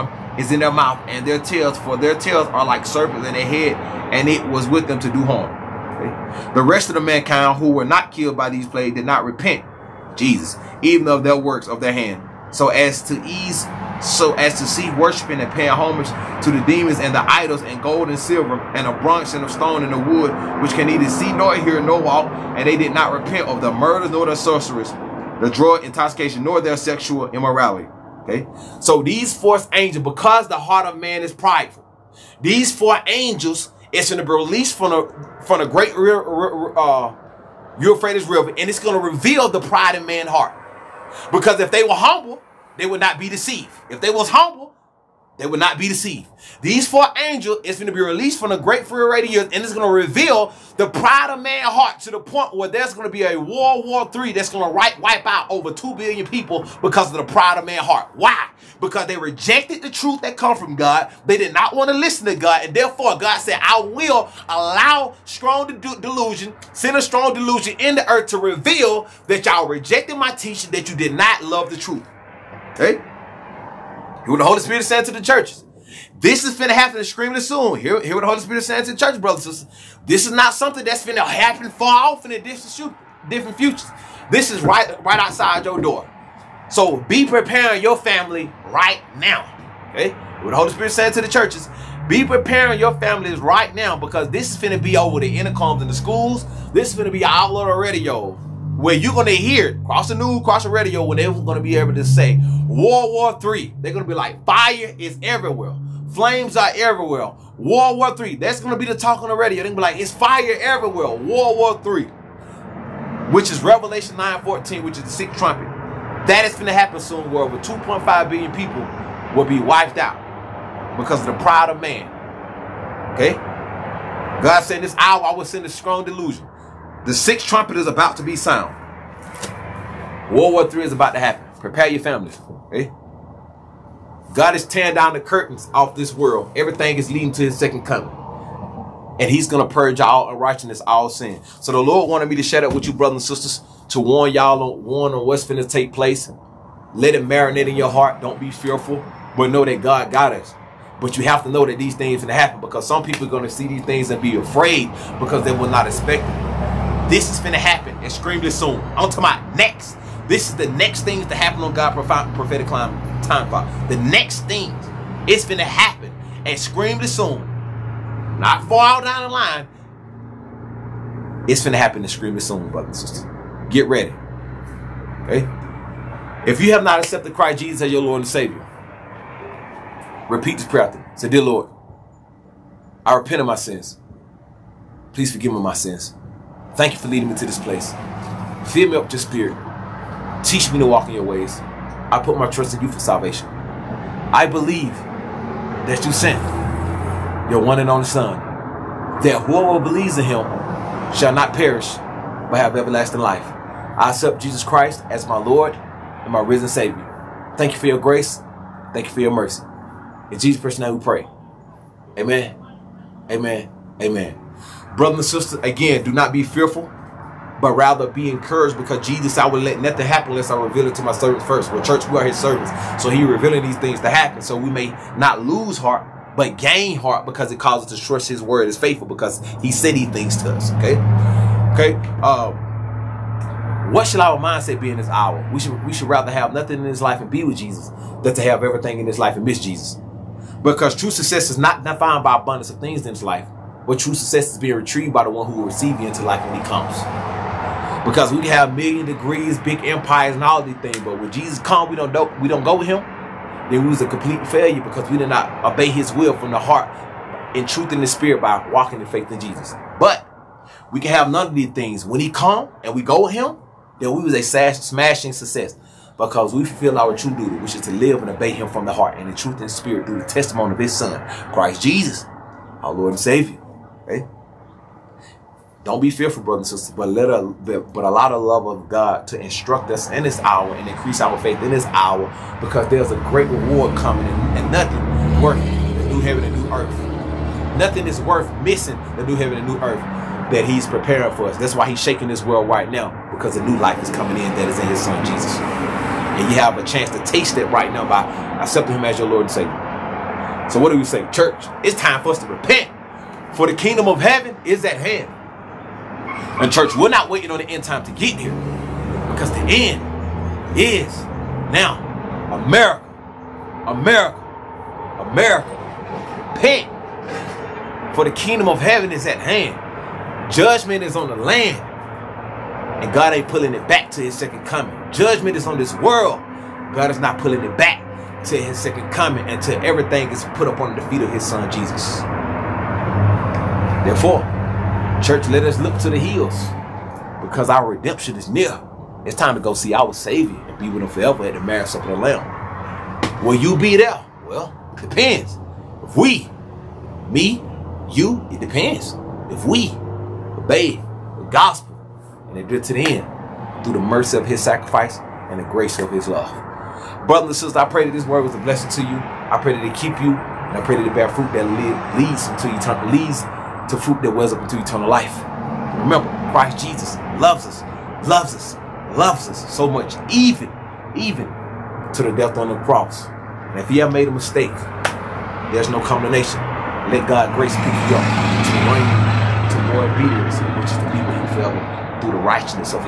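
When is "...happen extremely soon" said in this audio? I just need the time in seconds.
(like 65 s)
157 s.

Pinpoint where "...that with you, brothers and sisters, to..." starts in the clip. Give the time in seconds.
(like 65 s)
142 s.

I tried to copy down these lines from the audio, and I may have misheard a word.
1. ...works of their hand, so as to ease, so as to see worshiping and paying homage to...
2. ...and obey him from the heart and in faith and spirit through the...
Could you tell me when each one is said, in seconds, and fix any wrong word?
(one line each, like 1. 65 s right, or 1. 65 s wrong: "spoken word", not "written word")
1. 11 s right
2. 268 s wrong: "truth", not "faith".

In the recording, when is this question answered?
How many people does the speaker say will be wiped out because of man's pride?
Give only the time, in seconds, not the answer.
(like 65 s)
117 s.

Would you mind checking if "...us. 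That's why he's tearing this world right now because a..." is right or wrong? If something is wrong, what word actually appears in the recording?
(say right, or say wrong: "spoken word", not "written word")
wrong: "shaking", not "tearing".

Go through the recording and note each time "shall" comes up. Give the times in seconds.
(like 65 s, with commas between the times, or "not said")
201 s.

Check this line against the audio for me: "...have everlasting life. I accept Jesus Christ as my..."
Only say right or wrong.
right.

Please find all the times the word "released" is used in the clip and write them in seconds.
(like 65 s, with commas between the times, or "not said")
34 s, 48 s.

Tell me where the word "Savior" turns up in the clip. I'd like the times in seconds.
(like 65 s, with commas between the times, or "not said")
178 s, 206 s, 273 s, 299 s, 340 s.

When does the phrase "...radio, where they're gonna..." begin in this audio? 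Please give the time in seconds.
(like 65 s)
100 s.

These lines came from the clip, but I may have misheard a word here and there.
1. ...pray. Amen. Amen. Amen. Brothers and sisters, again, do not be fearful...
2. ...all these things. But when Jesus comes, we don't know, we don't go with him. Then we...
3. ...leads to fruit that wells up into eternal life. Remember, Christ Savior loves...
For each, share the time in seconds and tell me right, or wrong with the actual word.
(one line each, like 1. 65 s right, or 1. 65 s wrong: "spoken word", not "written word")
1. 211 s right
2. 250 s right
3. 363 s wrong: "Jesus", not "Savior".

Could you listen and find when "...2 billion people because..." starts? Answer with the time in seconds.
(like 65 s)
55 s.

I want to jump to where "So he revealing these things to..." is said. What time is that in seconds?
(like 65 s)
223 s.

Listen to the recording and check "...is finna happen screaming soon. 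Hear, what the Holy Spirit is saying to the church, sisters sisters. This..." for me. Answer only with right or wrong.
wrong.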